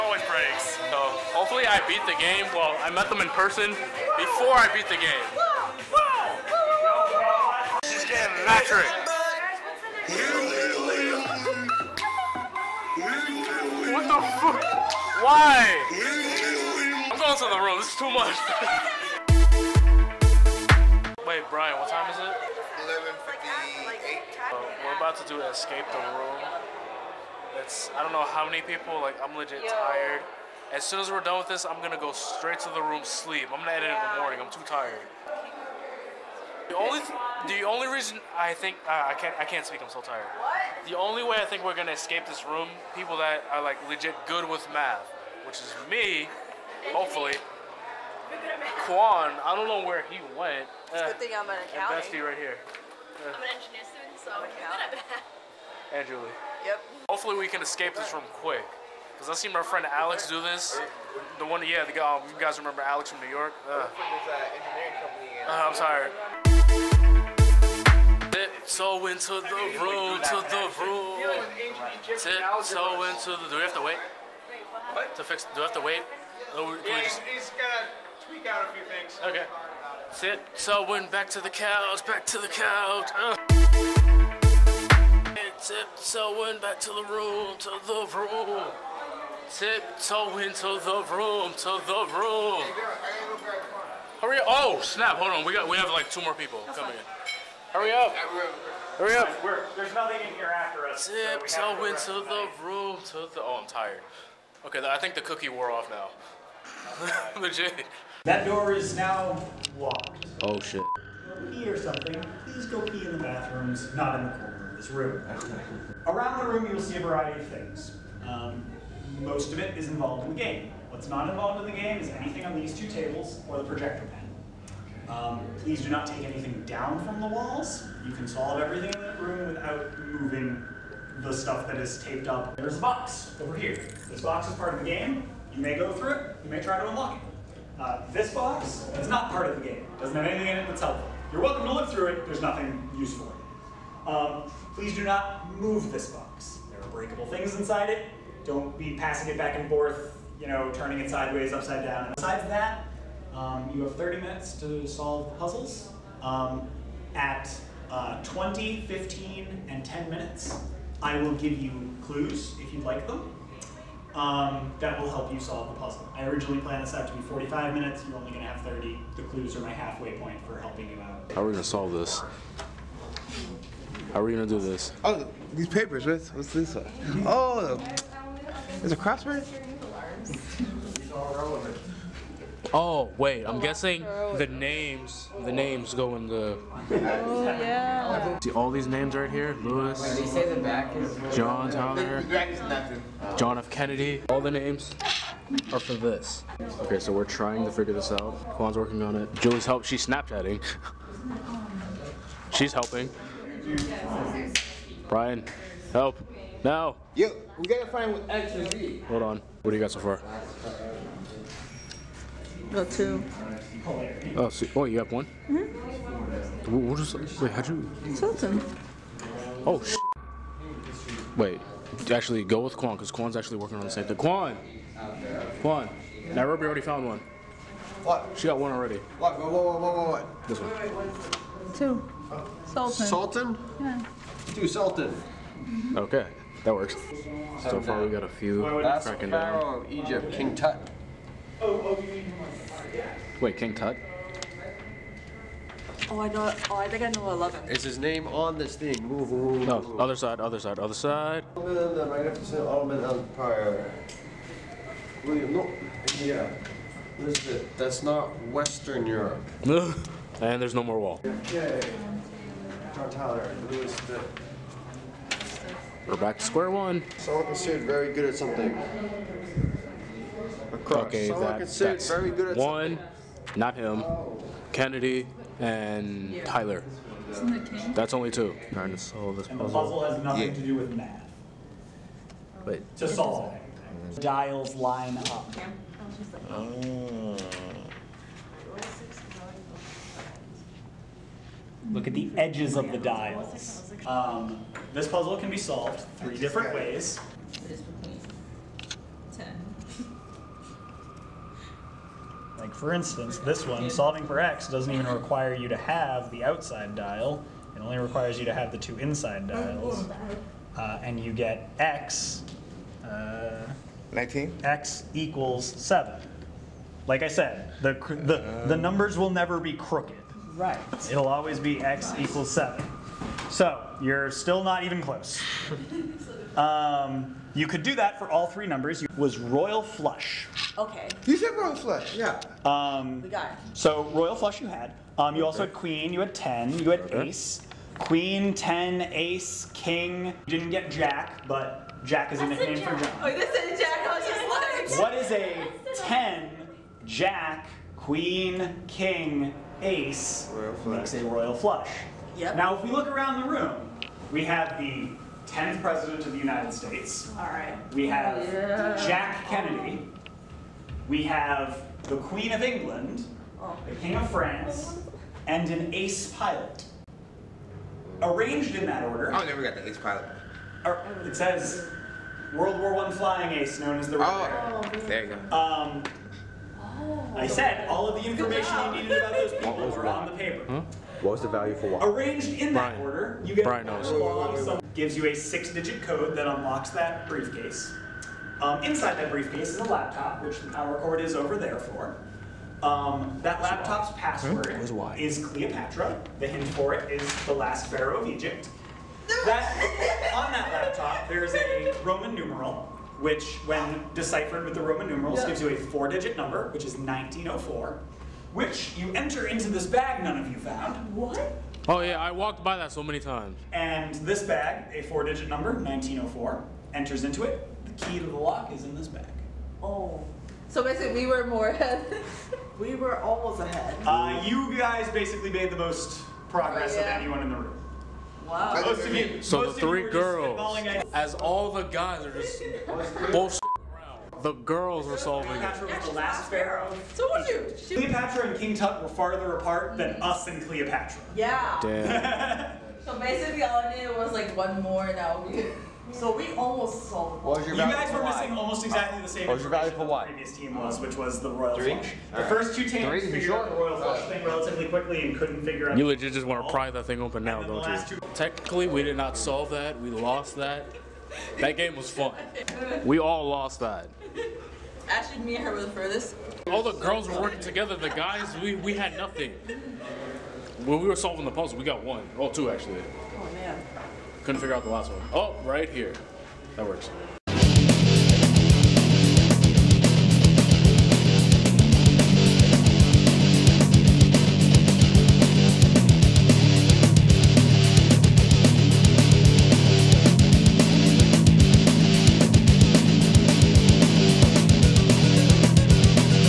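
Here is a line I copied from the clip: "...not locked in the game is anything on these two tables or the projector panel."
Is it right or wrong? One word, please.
wrong.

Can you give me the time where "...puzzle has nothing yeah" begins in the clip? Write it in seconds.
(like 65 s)
279 s.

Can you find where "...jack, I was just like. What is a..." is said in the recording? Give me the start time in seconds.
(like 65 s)
343 s.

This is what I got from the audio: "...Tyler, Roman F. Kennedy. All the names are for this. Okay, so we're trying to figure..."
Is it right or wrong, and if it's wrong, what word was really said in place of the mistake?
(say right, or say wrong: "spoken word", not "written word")
wrong: "John", not "Roman".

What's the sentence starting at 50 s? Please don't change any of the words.
It's a good thing I'm an accountant.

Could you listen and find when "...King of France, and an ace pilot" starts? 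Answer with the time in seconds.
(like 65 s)
363 s.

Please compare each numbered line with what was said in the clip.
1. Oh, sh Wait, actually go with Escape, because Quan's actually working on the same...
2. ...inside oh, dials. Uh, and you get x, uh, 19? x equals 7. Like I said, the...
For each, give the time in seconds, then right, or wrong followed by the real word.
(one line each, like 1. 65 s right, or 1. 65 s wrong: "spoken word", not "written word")
1. 219 s wrong: "Quan", not "Escape"
2. 308 s right.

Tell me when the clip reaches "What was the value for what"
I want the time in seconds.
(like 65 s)
381 s.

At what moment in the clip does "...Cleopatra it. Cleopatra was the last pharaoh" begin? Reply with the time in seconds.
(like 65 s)
435 s.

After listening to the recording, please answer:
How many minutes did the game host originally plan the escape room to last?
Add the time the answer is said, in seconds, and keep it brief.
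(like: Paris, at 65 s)
45, at 167 s.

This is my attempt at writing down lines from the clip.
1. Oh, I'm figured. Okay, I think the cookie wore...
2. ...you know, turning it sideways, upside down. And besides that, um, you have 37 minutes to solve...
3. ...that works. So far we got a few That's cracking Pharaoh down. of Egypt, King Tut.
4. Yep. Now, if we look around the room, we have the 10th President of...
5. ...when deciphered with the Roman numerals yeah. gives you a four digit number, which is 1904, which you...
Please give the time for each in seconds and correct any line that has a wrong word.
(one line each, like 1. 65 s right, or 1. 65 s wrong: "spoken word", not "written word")
1. 103 s wrong: "tired", not "figured"
2. 150 s wrong: "30", not "37"
3. 236 s right
4. 352 s right
5. 403 s right.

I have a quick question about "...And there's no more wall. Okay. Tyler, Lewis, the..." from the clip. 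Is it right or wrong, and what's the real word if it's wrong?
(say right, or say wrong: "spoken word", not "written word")
right.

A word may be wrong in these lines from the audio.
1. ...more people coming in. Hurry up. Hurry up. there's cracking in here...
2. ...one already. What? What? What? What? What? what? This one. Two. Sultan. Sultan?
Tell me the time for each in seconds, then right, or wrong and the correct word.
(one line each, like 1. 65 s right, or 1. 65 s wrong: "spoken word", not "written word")
1. 96 s wrong: "nothing", not "cracking"
2. 228 s right.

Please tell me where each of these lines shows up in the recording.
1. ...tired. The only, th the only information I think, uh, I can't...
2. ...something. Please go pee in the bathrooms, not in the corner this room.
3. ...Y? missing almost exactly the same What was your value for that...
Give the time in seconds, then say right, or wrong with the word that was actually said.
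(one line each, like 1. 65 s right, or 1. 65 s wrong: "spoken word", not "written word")
1. 34 s wrong: "reason", not "information"
2. 111 s right
3. 448 s right.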